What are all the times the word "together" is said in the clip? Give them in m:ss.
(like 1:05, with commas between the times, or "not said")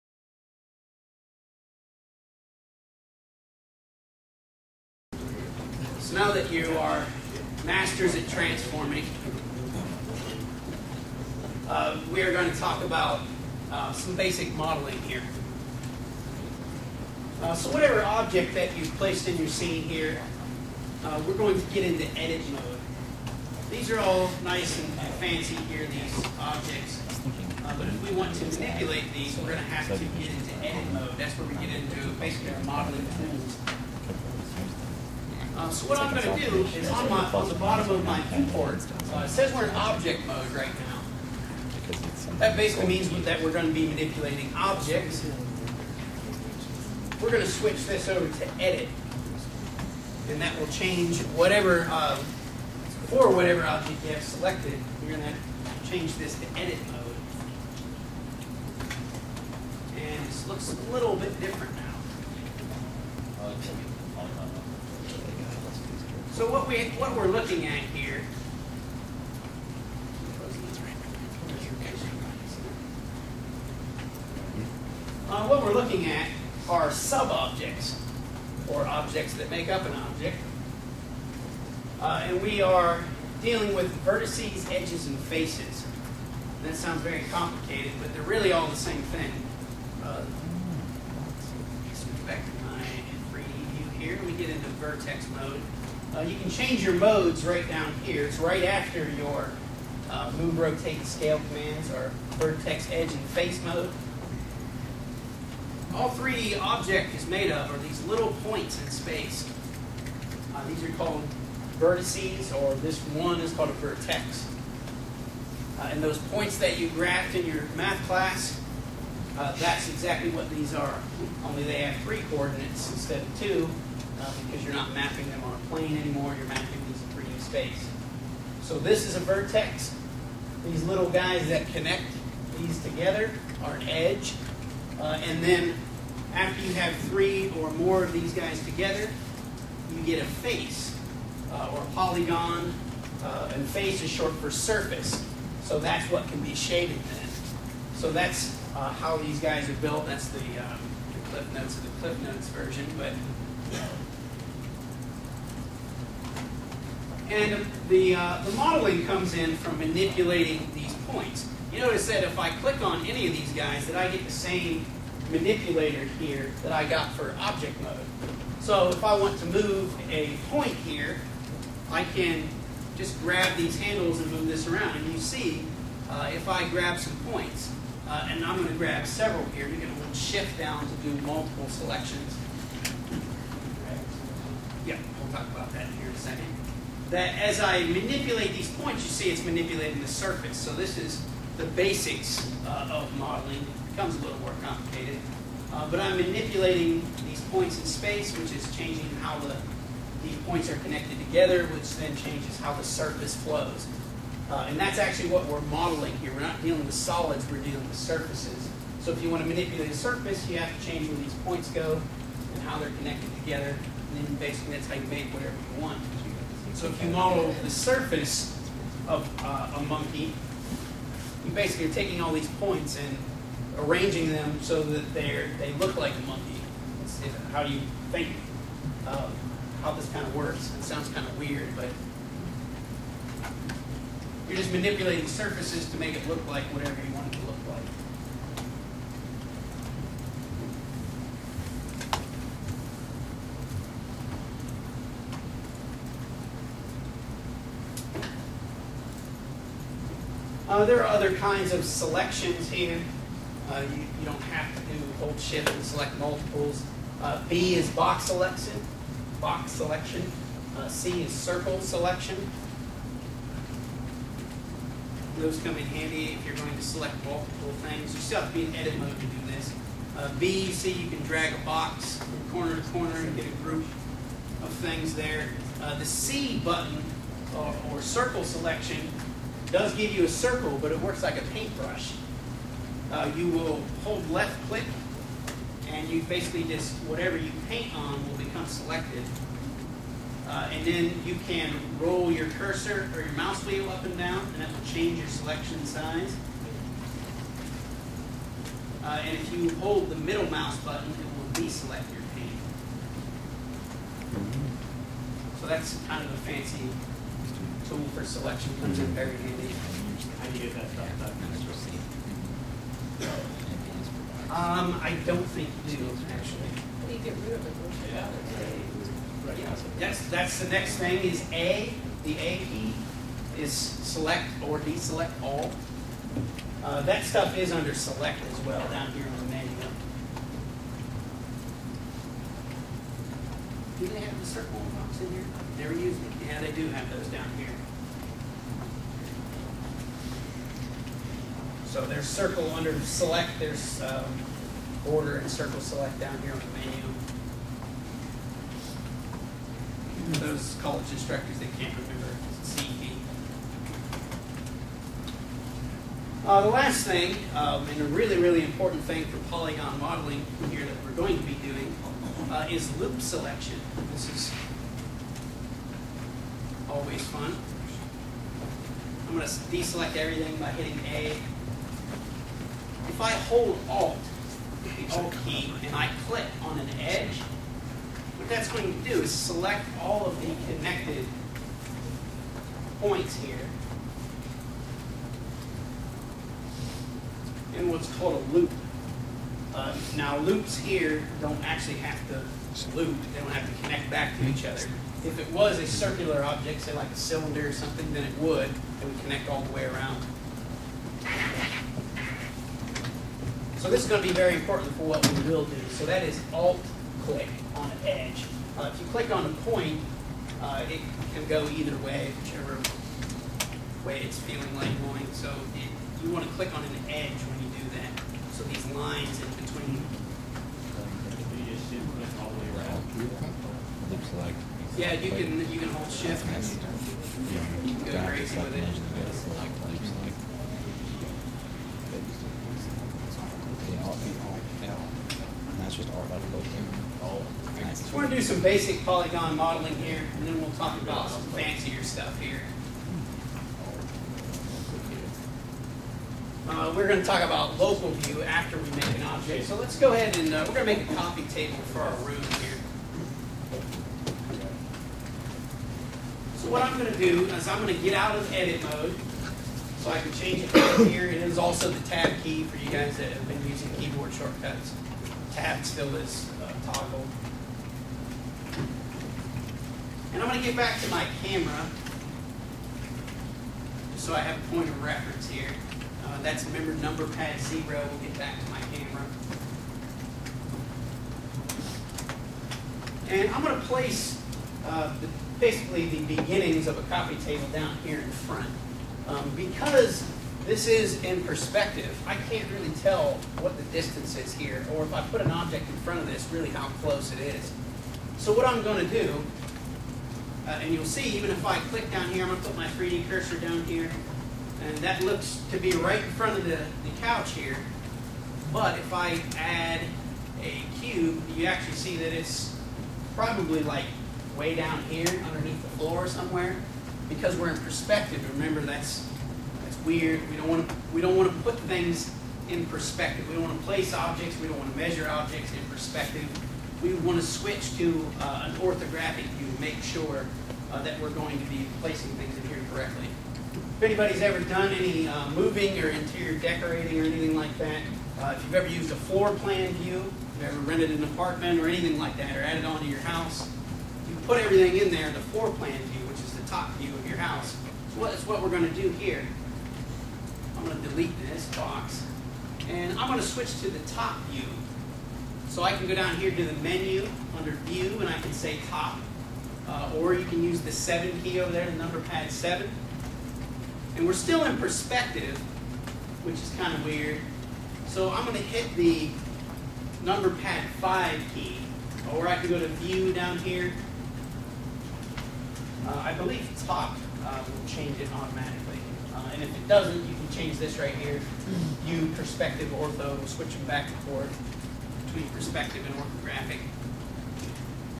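2:12, 2:18, 3:21, 3:33.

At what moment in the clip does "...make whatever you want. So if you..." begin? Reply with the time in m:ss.
3:35.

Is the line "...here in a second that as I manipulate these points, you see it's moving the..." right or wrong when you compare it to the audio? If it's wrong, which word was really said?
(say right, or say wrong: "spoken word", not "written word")
wrong: "manipulating", not "moving".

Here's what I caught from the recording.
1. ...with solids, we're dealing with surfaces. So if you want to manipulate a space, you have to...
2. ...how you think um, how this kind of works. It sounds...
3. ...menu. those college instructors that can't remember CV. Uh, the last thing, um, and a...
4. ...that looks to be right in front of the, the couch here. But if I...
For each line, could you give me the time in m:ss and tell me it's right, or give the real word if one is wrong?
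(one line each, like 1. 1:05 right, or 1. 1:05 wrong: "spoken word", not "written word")
1. 3:26 wrong: "surface", not "space"
2. 3:47 right
3. 5:46 right
4. 8:24 right.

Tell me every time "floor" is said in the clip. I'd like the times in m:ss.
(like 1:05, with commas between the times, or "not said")
8:35, 8:59, 9:05.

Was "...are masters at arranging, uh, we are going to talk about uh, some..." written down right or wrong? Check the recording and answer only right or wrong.
wrong.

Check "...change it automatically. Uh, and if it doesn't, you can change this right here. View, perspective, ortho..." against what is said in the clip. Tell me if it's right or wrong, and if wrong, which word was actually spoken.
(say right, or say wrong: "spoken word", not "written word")
right.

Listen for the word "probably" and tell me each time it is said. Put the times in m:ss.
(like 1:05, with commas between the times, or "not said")
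8:33.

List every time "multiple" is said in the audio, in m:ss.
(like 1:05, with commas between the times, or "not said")
3:01, 4:16, 4:27.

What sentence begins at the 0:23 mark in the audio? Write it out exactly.
These are all nice and fancy here, these objects.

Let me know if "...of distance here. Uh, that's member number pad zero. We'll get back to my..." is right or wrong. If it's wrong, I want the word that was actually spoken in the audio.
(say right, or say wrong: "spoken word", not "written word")
wrong: "reference", not "distance".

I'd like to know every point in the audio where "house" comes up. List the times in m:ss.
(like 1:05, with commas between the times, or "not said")
9:03, 9:07.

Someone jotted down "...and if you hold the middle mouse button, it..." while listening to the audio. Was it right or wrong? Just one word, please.
right.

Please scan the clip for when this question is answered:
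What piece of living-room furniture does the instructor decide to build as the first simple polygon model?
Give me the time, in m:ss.
8:07.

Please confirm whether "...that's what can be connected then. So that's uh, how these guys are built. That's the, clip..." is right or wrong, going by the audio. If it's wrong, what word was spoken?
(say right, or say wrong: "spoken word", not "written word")
wrong: "shaded", not "connected".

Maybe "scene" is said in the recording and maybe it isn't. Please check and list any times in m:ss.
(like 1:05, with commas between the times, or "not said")
0:19.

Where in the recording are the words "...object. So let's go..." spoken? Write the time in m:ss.
7:29.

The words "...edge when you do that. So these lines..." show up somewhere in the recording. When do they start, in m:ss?
6:57.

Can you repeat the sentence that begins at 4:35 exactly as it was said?
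Uh, the C button or, or circle selection does give you a circle, but it works like a paintbrush.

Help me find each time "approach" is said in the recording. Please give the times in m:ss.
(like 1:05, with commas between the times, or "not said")
not said.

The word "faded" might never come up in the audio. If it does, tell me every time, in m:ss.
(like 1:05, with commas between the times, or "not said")
not said.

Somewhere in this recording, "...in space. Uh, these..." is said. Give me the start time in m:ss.
1:48.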